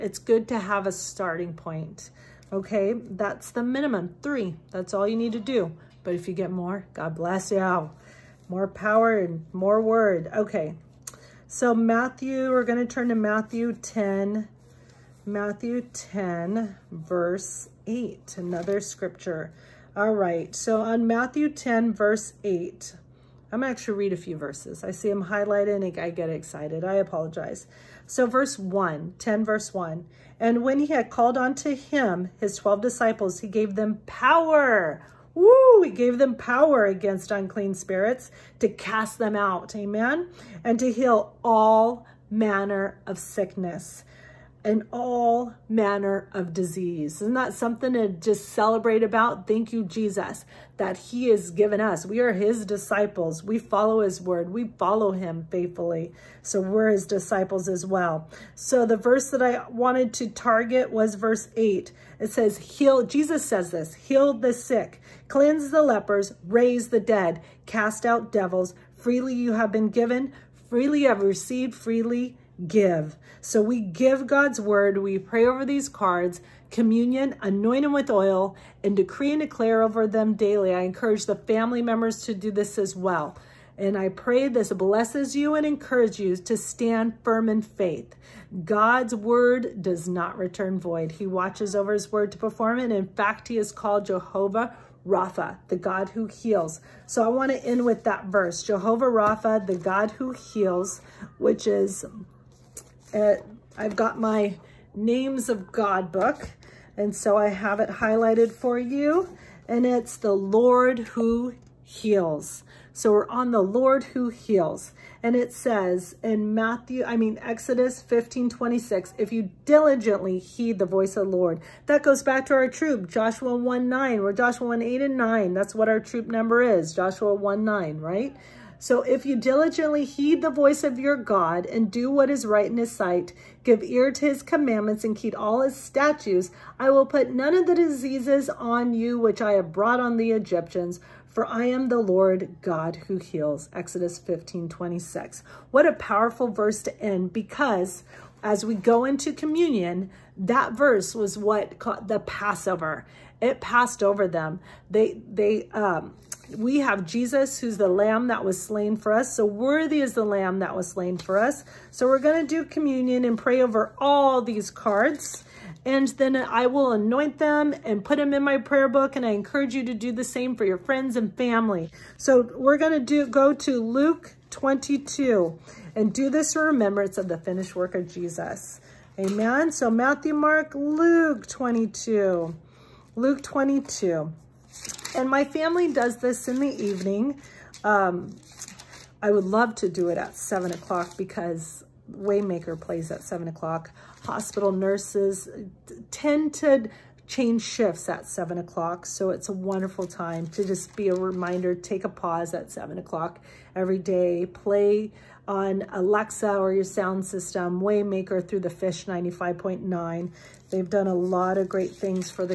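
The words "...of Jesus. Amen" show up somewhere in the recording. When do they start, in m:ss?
2:57.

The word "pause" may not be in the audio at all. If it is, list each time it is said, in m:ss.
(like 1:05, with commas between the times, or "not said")
3:22.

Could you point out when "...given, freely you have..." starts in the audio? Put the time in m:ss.
1:09.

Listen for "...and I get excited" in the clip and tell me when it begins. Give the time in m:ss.
0:25.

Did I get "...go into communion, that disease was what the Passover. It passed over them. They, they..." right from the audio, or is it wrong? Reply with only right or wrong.
wrong.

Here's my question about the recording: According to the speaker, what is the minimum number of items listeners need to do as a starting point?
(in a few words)
3.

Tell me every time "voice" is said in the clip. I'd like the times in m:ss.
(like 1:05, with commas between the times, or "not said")
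2:00, 2:10.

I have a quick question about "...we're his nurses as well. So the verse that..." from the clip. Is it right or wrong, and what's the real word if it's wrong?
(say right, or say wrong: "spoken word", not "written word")
wrong: "disciples", not "nurses".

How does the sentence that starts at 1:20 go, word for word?
I encourage the family members to do this as well.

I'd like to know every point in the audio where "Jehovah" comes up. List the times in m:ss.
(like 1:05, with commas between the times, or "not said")
1:34, 1:38.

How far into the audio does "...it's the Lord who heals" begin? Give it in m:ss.
1:49.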